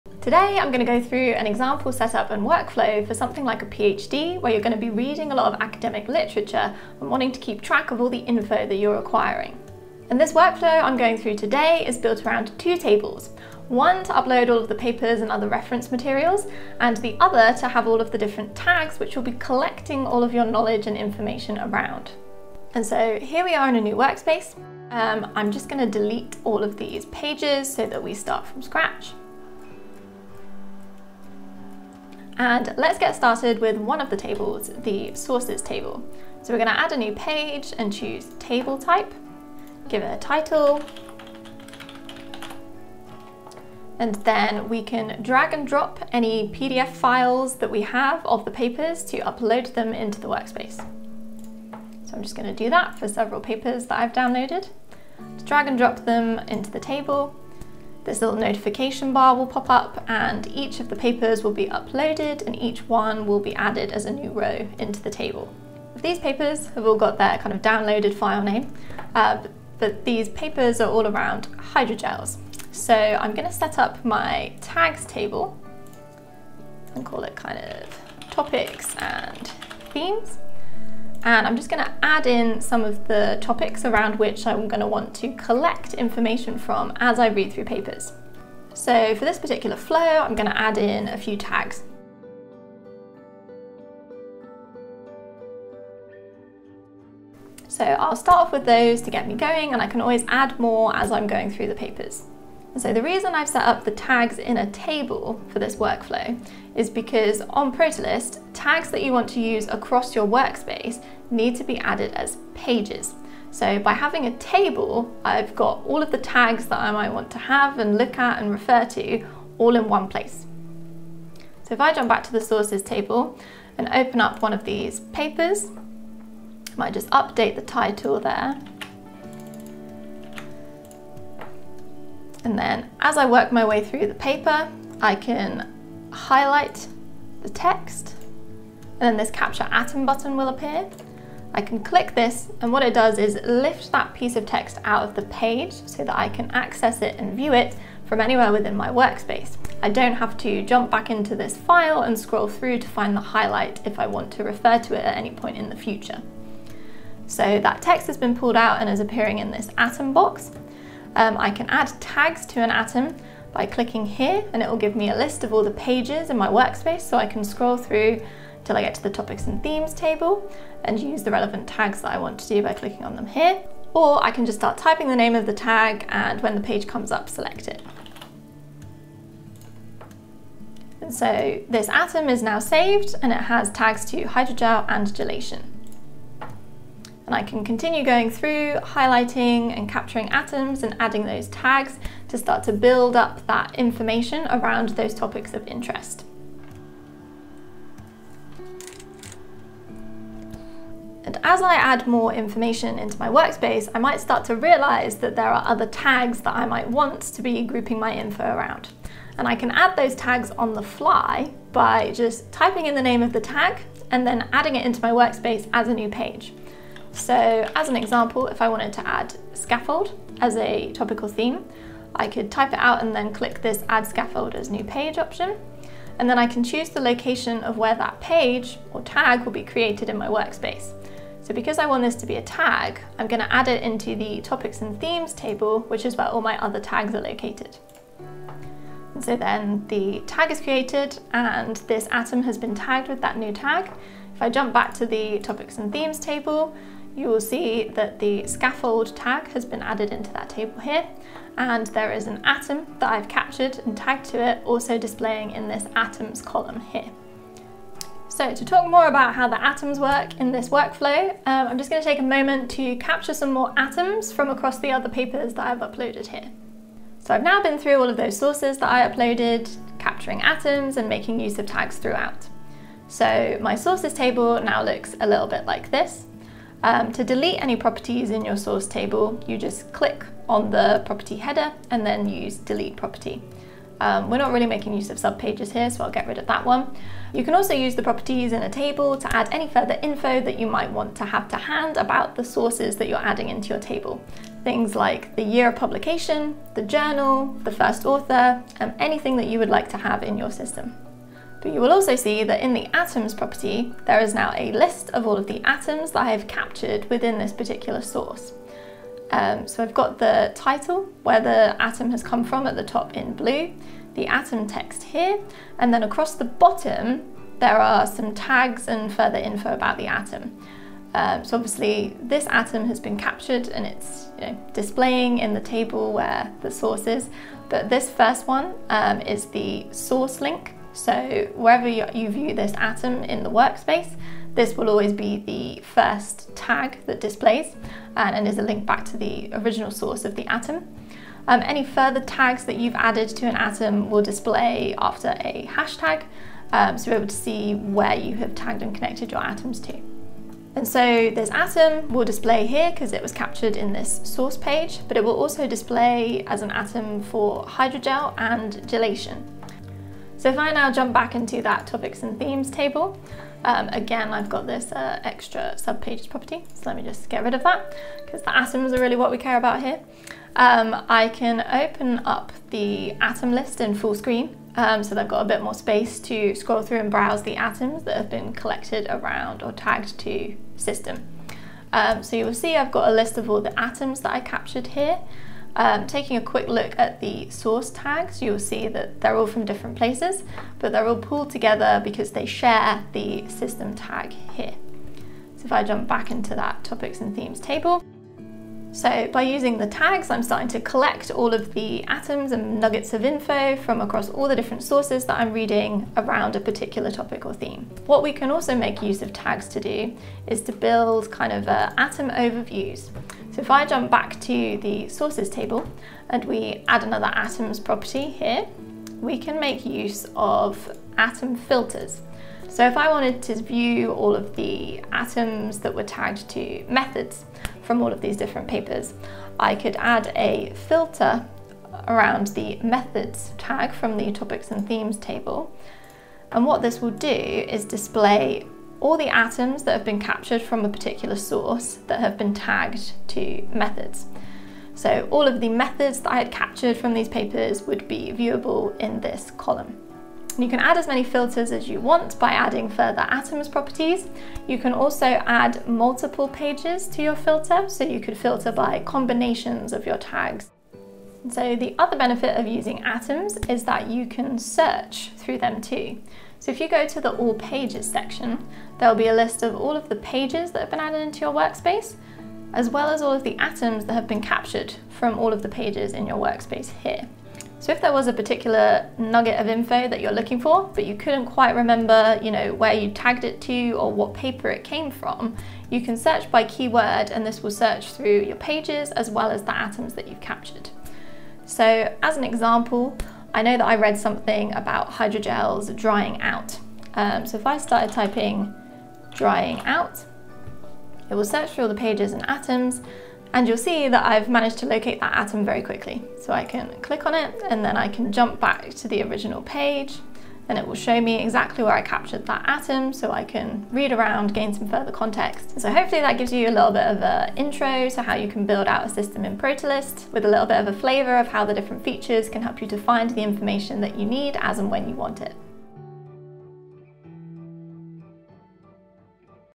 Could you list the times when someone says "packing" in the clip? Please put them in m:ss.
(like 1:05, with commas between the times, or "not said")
not said.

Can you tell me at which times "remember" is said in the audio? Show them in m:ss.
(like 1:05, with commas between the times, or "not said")
8:01.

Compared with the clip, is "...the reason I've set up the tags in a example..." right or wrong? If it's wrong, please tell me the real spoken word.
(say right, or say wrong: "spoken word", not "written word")
wrong: "table", not "example".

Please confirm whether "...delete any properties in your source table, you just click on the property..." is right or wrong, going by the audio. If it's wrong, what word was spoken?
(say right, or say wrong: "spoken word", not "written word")
right.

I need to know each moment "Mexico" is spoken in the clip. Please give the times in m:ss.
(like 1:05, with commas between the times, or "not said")
not said.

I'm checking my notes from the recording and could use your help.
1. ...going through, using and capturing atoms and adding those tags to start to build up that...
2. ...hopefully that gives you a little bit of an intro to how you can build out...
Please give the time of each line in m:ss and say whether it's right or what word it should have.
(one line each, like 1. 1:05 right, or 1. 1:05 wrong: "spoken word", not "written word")
1. 3:08 wrong: "highlighting", not "using"
2. 8:35 right.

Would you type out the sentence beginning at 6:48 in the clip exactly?
What we can also make use of tags to do is to build kind of uh, atom overviews.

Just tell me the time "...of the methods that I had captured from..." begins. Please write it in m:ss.
7:25.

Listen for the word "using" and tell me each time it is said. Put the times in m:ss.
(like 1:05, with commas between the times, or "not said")
6:39, 7:42.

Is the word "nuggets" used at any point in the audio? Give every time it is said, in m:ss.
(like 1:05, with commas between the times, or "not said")
6:42, 7:59.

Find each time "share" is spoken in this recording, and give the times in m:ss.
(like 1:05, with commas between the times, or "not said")
6:32.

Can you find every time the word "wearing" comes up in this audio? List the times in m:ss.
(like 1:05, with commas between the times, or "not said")
not said.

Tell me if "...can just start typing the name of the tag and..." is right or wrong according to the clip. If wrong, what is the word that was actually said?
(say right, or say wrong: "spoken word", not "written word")
right.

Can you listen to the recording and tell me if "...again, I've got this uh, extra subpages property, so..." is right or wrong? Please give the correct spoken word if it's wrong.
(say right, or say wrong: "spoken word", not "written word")
right.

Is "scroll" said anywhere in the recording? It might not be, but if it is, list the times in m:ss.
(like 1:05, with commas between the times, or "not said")
2:32, 2:47, 6:16.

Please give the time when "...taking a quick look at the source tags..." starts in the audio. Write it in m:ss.
6:26.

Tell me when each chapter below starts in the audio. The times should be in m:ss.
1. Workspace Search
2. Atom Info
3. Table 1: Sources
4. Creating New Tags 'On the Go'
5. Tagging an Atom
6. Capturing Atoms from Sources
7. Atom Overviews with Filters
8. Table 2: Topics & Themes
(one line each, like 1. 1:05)
1. 7:41
2. 5:09
3. 0:32
4. 3:21
5. 2:40
6. 2:05
7. 6:48
8. 1:12.